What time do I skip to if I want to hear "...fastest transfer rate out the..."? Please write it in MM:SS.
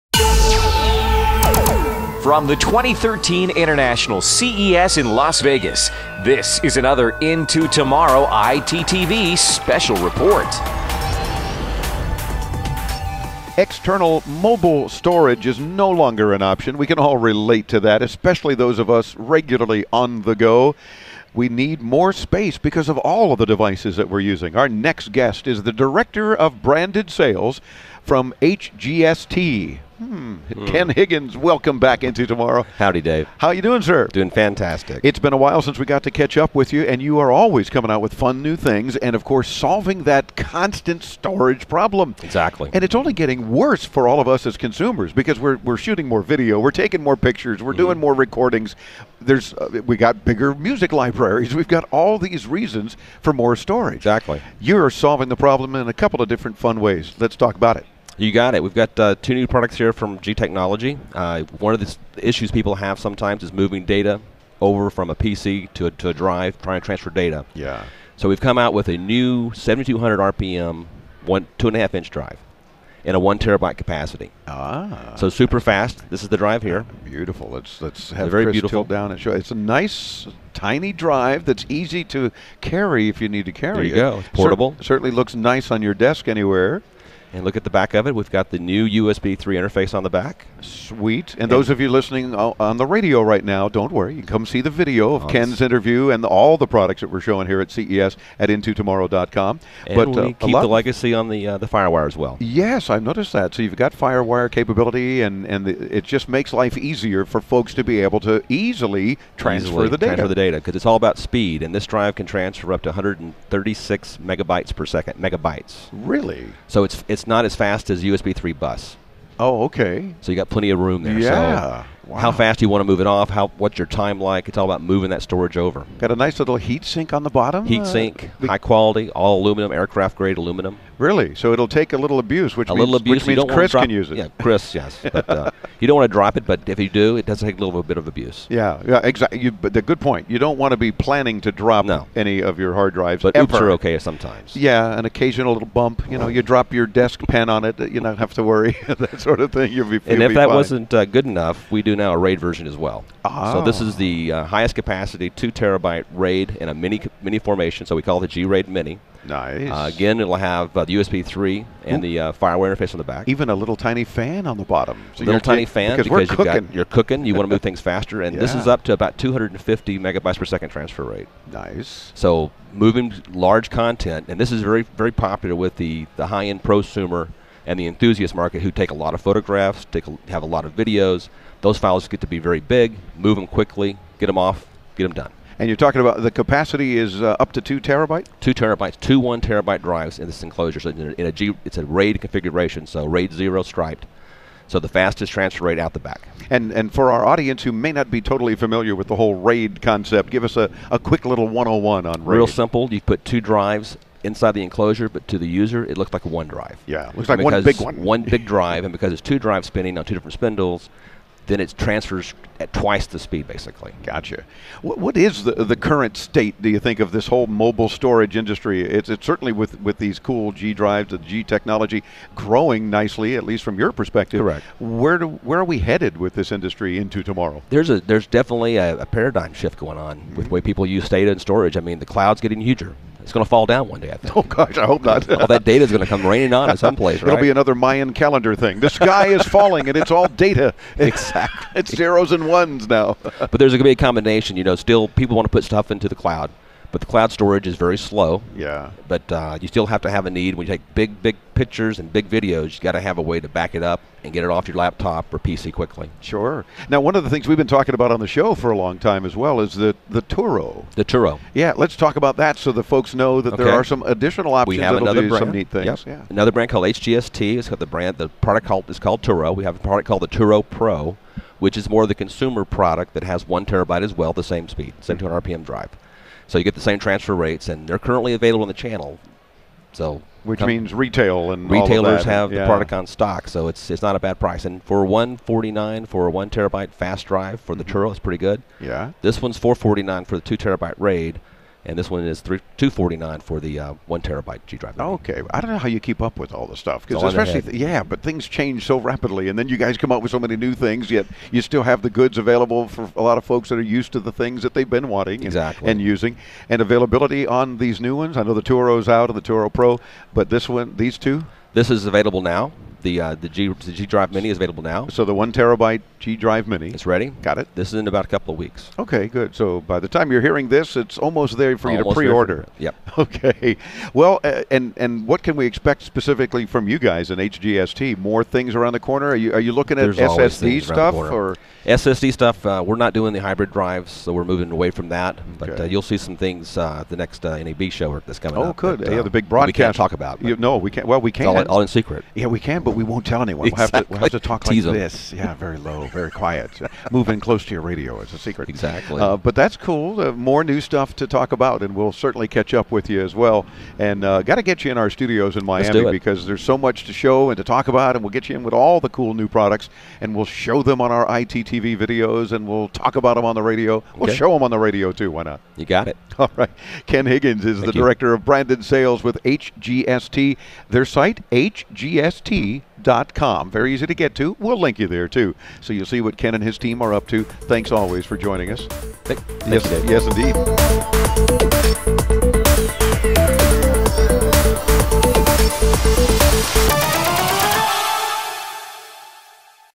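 03:14.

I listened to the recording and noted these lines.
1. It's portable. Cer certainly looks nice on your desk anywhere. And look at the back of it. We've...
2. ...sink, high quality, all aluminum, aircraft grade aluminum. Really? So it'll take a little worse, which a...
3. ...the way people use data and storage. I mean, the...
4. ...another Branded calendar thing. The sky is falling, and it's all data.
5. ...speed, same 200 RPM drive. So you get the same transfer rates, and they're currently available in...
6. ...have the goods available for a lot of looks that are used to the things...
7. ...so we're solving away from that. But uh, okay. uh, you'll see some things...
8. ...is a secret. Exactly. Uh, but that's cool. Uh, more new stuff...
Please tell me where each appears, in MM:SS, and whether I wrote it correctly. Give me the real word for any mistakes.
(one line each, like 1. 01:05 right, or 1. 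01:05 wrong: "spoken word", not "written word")
1. 01:24 right
2. 02:07 wrong: "abuse", not "worse"
3. 03:50 right
4. 03:57 wrong: "Mayan", not "Branded"
5. 04:34 right
6. 05:01 wrong: "folks", not "looks"
7. 05:34 wrong: "moving", not "solving"
8. 05:48 right.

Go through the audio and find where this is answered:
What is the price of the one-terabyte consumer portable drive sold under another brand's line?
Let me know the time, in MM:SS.
04:45.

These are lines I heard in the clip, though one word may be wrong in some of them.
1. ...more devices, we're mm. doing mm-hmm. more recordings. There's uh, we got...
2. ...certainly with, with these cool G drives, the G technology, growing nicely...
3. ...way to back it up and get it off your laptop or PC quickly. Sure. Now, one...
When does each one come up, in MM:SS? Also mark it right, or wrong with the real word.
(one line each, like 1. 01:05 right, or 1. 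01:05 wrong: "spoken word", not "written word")
1. 00:47 wrong: "pictures", not "devices"
2. 03:39 right
3. 04:13 right.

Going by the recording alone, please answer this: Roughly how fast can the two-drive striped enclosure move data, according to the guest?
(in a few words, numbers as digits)
250 megabytes per second.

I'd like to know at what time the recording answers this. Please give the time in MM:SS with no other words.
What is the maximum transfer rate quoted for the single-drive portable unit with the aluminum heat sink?
01:52.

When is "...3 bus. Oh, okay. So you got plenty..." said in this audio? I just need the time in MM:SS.
01:58.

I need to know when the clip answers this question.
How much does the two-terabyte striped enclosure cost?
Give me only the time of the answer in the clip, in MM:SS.
04:49.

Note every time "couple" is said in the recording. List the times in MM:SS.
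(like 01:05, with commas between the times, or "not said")
00:55, 05:18.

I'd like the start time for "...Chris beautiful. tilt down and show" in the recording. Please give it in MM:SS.
01:18.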